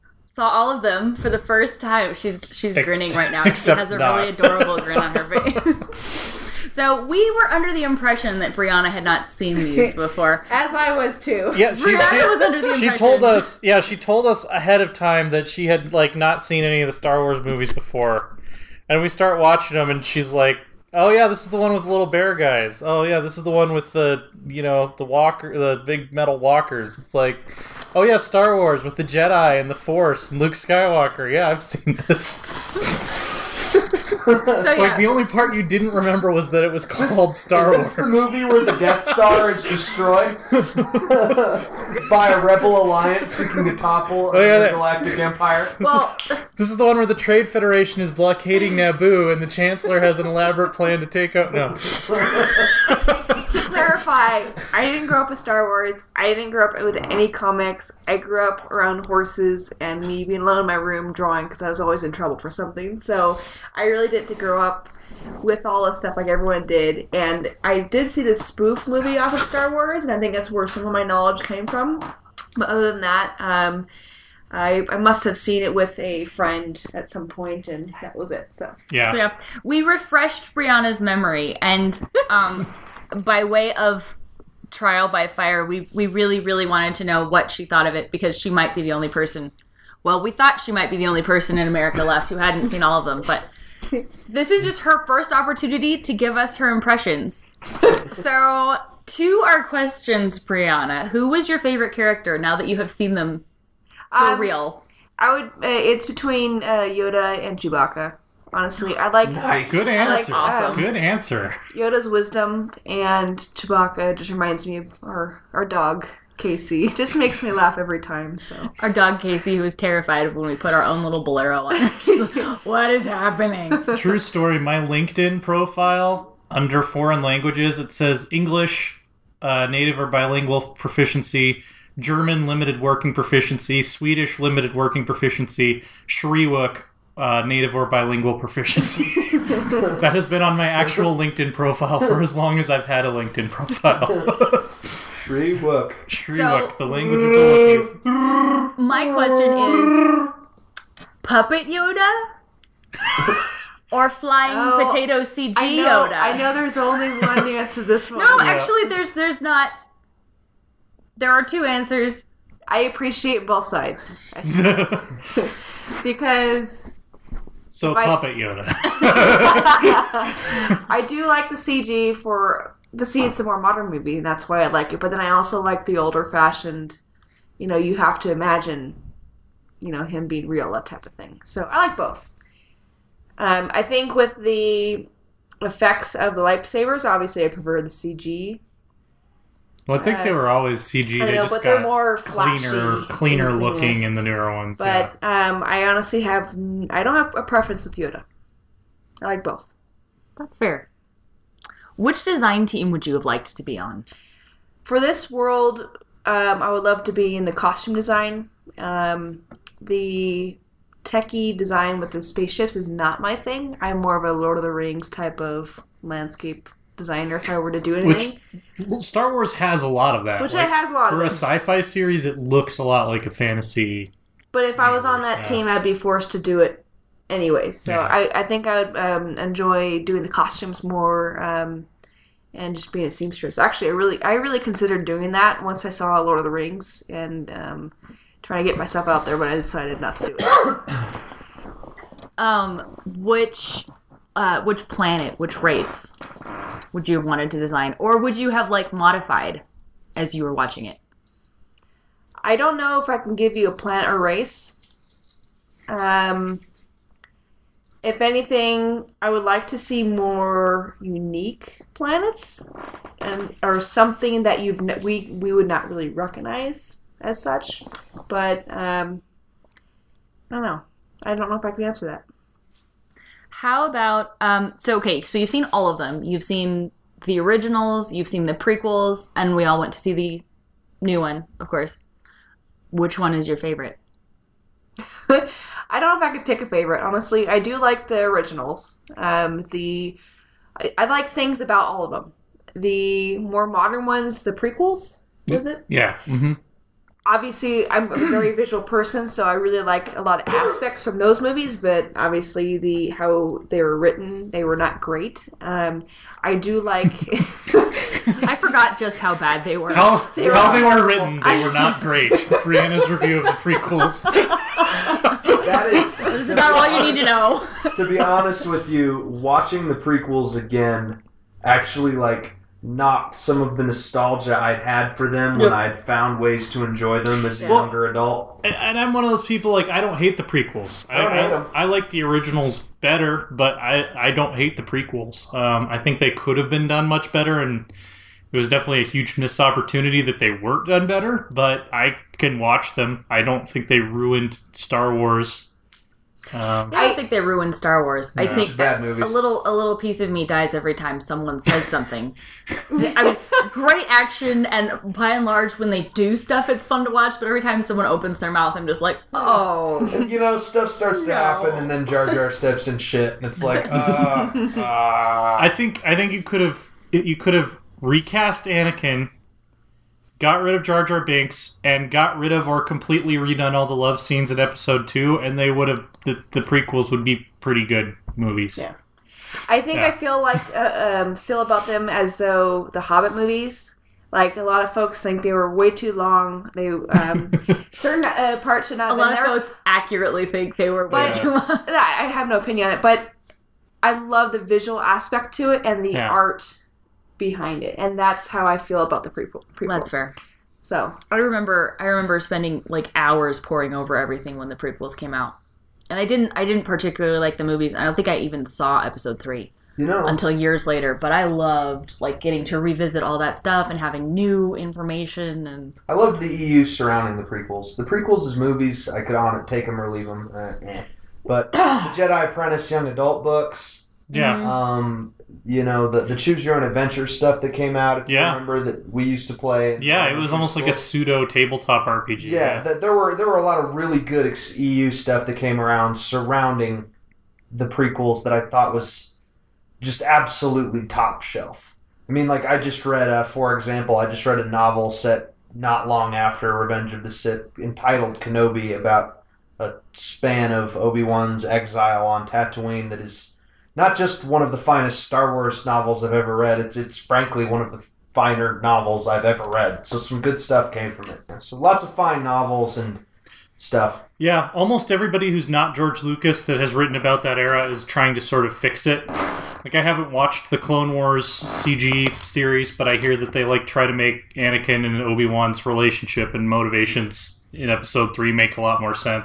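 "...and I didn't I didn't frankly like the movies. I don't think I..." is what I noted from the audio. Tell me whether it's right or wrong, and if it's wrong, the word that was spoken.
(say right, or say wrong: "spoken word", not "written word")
wrong: "particularly", not "frankly".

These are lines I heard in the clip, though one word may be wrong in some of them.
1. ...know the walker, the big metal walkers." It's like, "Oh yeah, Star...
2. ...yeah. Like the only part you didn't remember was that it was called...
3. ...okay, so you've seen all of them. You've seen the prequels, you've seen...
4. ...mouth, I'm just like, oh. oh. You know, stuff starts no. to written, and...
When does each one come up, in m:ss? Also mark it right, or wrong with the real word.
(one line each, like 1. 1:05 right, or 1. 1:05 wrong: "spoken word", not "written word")
1. 0:24 right
2. 0:34 right
3. 4:34 wrong: "originals", not "prequels"
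4. 5:58 wrong: "happen", not "written".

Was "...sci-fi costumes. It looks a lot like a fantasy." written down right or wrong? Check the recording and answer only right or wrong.
wrong.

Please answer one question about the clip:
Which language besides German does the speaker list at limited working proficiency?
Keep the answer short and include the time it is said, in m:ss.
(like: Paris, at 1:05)
Swedish, at 2:13.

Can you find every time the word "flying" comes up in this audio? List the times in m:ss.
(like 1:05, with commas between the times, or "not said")
2:34.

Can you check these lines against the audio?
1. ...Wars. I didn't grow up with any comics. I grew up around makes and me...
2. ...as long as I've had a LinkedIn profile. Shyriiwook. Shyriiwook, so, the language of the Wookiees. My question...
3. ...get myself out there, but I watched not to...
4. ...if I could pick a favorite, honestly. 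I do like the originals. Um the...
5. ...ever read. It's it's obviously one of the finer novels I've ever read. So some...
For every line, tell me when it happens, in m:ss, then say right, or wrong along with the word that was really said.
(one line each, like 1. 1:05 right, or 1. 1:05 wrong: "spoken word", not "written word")
1. 0:55 wrong: "horses", not "makes"
2. 2:22 right
3. 3:58 wrong: "decided", not "watched"
4. 4:46 right
5. 7:36 wrong: "frankly", not "obviously".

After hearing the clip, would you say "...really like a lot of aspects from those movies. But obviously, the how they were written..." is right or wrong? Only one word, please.
right.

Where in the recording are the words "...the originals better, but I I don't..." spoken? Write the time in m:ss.
5:32.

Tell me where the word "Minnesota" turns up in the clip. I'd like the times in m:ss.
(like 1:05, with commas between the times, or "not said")
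not said.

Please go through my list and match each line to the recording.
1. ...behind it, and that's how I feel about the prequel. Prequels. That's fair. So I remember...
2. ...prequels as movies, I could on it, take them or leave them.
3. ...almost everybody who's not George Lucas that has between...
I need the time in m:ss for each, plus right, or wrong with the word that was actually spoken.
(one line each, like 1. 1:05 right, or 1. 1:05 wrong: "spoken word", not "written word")
1. 6:37 right
2. 6:58 right
3. 7:44 wrong: "written", not "between".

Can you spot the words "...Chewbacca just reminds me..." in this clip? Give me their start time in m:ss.
1:53.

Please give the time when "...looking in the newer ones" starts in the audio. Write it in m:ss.
3:13.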